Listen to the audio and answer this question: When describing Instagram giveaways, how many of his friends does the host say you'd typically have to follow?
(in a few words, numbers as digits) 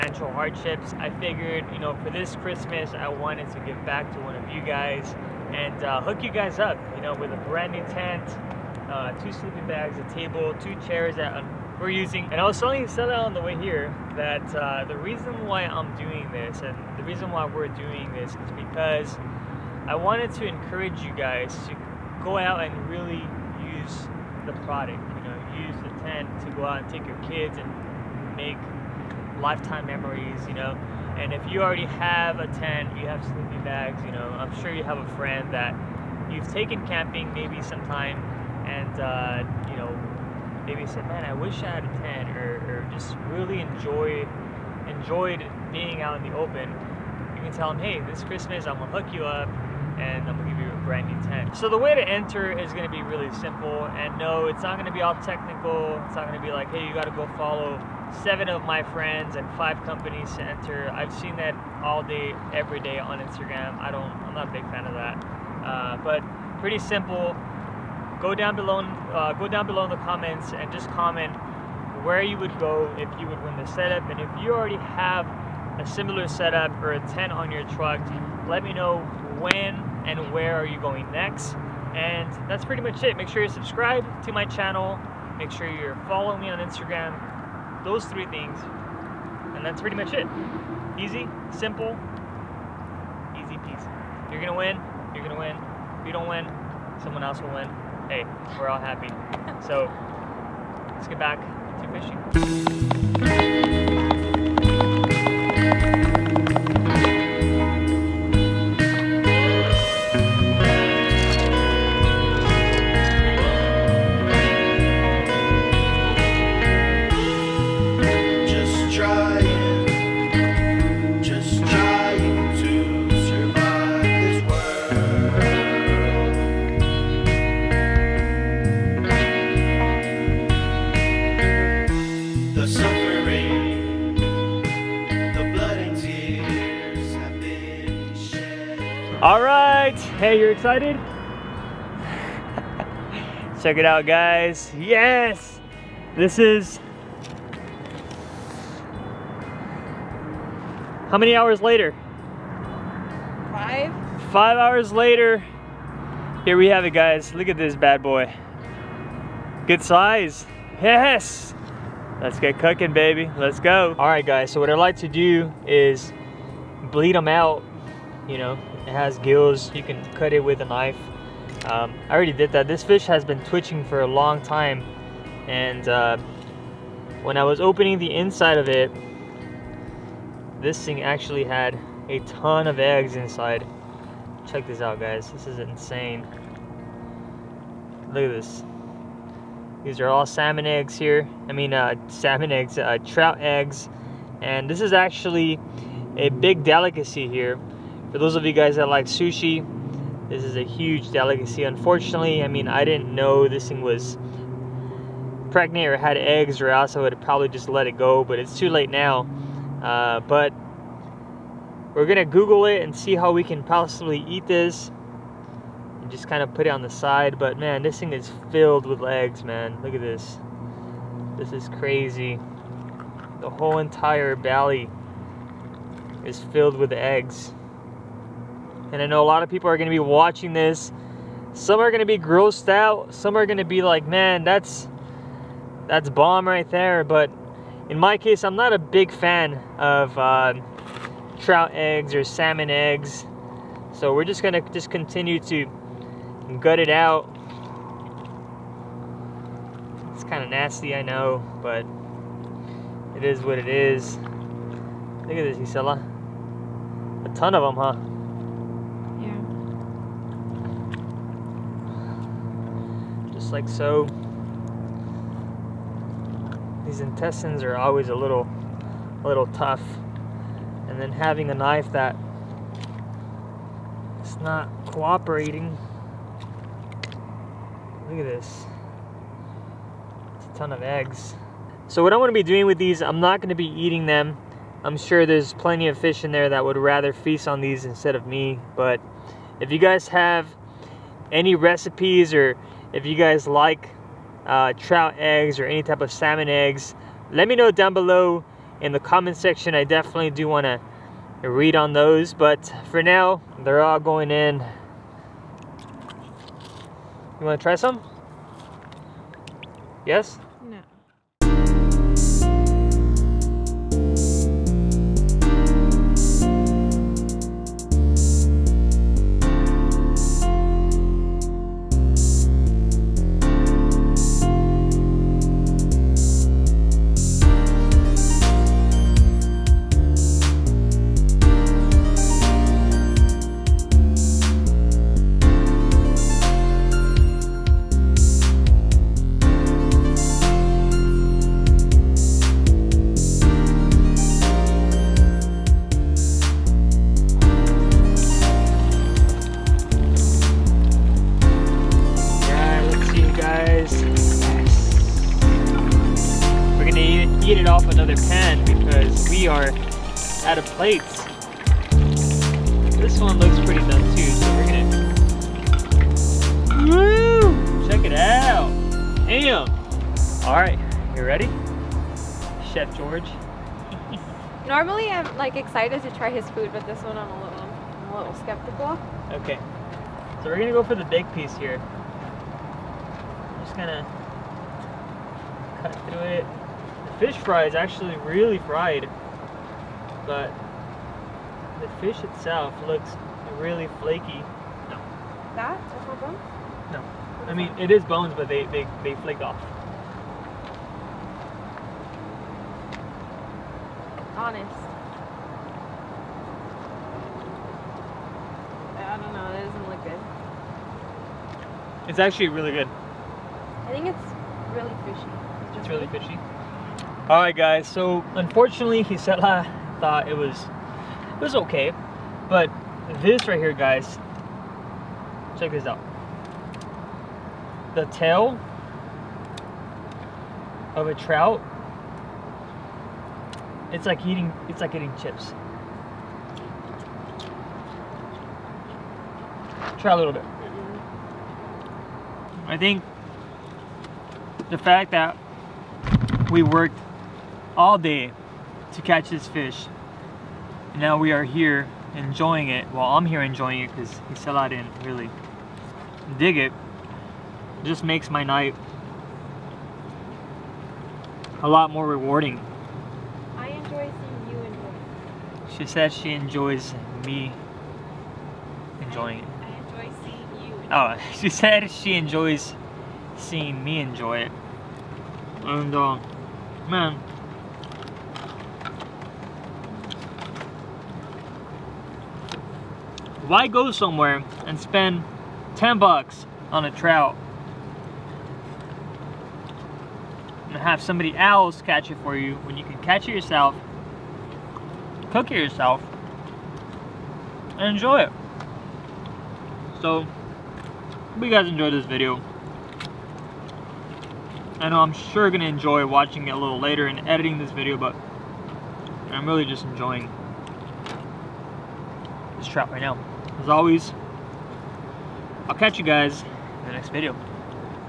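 7.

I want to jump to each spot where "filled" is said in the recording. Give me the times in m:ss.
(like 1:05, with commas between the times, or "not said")
3:38, 3:46.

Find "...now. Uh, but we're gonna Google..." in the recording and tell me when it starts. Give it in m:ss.
3:28.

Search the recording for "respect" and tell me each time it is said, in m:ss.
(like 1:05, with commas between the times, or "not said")
not said.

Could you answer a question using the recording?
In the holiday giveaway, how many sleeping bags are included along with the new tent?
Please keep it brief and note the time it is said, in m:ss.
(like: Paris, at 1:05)
2, at 0:09.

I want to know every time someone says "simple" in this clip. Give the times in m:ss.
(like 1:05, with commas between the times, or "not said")
0:53, 1:06, 1:31.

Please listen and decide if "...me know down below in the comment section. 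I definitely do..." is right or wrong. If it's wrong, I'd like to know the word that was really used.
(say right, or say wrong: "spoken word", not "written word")
right.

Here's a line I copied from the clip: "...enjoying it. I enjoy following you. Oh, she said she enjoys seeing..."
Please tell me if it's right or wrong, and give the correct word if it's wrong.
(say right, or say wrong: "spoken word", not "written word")
wrong: "seeing", not "following".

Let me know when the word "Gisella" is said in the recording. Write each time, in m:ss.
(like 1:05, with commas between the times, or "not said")
4:15, 6:59.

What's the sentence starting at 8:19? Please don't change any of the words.
So, hope you guys enjoyed this video.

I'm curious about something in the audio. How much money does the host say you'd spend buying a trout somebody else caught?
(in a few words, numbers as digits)
$10.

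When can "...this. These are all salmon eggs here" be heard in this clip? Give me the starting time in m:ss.
3:08.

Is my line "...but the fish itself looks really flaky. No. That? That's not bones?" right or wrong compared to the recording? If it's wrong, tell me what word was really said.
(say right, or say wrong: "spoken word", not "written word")
right.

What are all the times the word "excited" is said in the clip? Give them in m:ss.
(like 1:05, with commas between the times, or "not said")
2:20, 6:15.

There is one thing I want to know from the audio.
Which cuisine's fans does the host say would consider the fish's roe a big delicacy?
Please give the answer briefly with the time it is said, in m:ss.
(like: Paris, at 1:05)
Sushi, at 3:19.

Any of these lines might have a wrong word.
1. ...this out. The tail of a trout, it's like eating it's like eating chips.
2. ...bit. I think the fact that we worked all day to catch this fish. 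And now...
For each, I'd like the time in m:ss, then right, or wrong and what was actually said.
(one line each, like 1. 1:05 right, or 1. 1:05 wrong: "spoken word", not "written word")
1. 7:05 right
2. 7:20 right.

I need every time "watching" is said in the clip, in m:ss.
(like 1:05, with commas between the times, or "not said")
3:49, 8:26.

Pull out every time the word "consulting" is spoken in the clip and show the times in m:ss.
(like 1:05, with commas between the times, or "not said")
not said.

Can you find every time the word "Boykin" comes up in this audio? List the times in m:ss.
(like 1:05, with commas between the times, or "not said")
not said.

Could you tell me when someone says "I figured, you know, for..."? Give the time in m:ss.
0:00.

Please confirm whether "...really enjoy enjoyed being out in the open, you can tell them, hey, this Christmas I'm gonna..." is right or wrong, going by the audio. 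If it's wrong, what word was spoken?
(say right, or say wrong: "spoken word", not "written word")
right.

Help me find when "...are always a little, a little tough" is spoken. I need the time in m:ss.
4:27.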